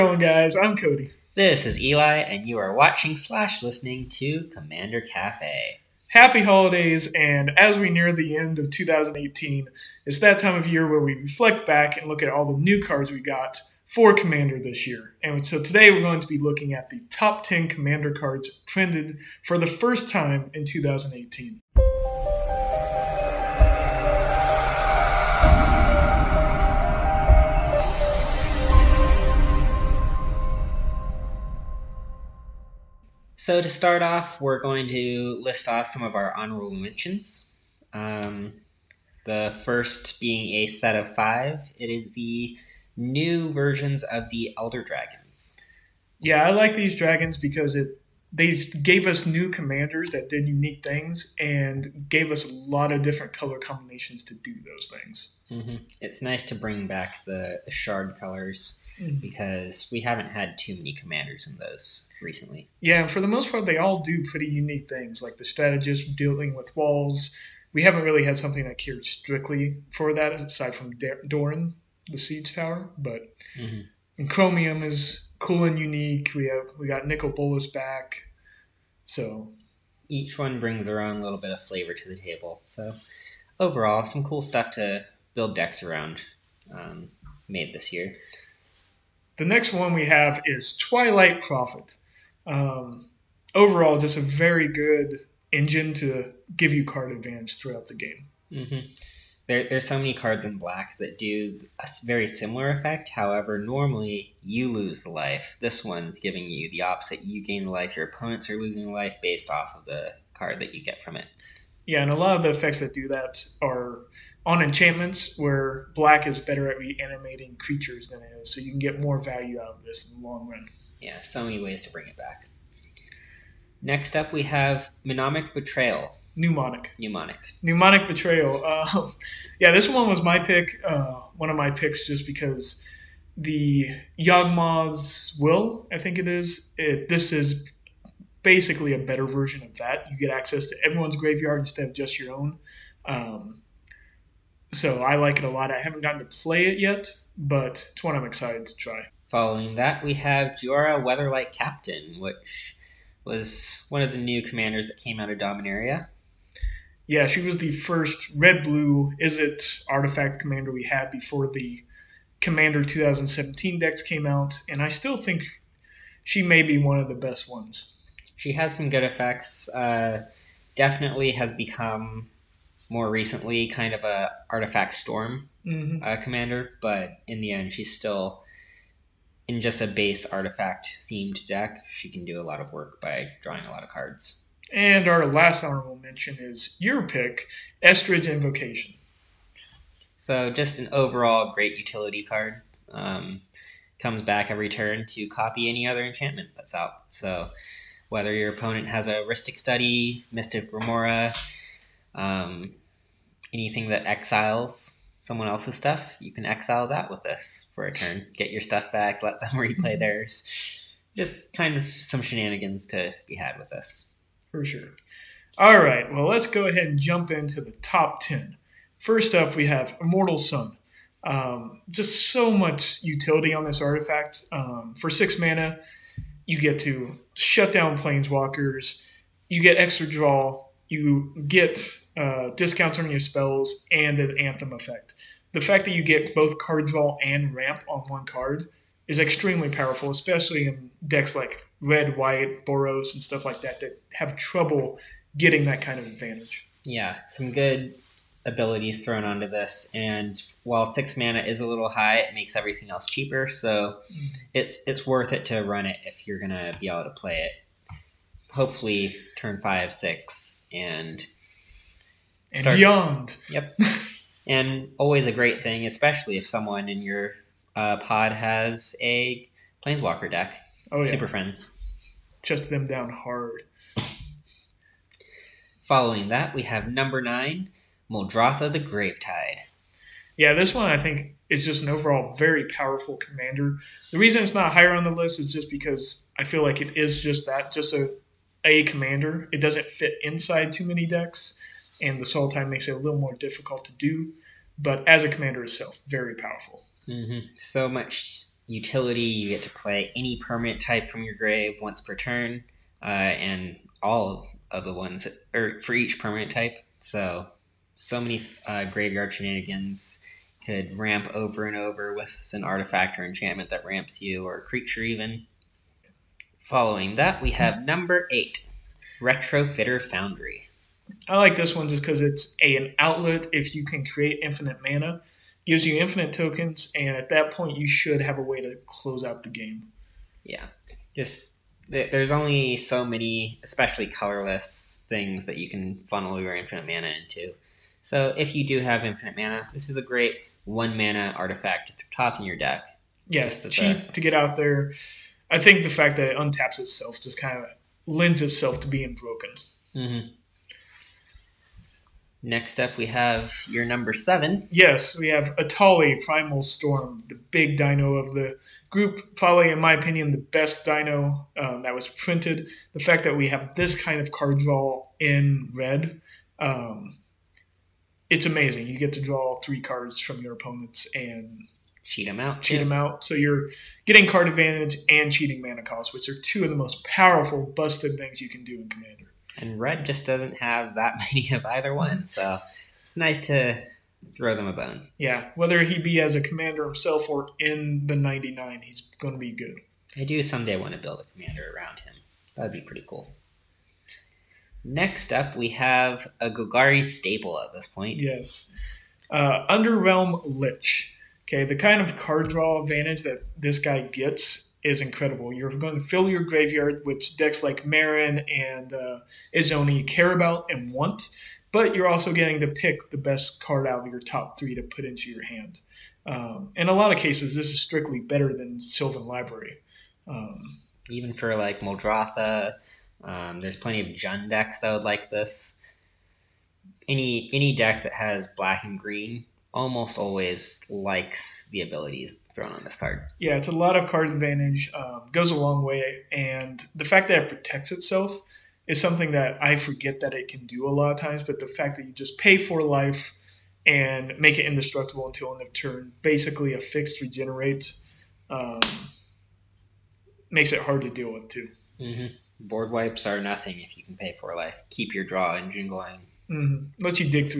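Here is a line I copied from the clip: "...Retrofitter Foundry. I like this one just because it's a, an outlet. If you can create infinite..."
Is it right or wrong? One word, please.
right.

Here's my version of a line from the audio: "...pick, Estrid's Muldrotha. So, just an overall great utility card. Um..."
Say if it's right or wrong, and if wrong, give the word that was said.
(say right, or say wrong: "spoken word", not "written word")
wrong: "Invocation", not "Muldrotha".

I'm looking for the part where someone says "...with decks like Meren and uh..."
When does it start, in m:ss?
6:47.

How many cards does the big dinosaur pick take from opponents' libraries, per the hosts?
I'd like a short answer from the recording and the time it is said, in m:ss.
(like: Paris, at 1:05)
3, at 6:09.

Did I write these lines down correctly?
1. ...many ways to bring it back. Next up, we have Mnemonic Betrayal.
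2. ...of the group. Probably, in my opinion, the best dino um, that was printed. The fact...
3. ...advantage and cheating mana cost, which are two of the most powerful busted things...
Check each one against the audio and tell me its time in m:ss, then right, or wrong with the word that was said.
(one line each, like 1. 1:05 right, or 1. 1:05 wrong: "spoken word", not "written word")
1. 2:01 right
2. 5:58 right
3. 6:14 right.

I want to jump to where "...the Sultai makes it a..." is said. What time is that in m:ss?
4:52.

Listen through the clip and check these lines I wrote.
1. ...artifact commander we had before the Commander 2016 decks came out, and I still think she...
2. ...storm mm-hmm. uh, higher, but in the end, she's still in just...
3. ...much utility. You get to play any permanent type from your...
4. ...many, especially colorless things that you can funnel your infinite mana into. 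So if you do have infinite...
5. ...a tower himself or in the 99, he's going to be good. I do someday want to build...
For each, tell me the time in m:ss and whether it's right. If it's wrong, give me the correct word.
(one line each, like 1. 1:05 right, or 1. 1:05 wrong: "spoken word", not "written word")
1. 2:39 wrong: "2017", not "2016"
2. 2:54 wrong: "commander", not "higher"
3. 4:57 right
4. 5:33 right
5. 6:26 wrong: "commander", not "tower".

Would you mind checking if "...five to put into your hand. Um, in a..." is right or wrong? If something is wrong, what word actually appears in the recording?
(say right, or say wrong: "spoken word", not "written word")
wrong: "three", not "five".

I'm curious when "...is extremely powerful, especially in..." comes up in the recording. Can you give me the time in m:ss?
3:59.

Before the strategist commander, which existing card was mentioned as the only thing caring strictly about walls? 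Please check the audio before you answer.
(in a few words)
Doran, the Siege Tower.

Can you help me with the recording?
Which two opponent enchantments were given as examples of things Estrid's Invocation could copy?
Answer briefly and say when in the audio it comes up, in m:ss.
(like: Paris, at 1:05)
Rhystic Study, Mystic Remora, at 3:19.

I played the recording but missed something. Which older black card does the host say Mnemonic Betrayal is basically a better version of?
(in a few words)
Yawgmoth's Will.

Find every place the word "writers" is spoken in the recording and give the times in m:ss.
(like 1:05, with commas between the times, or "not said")
not said.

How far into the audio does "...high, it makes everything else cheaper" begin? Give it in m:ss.
4:11.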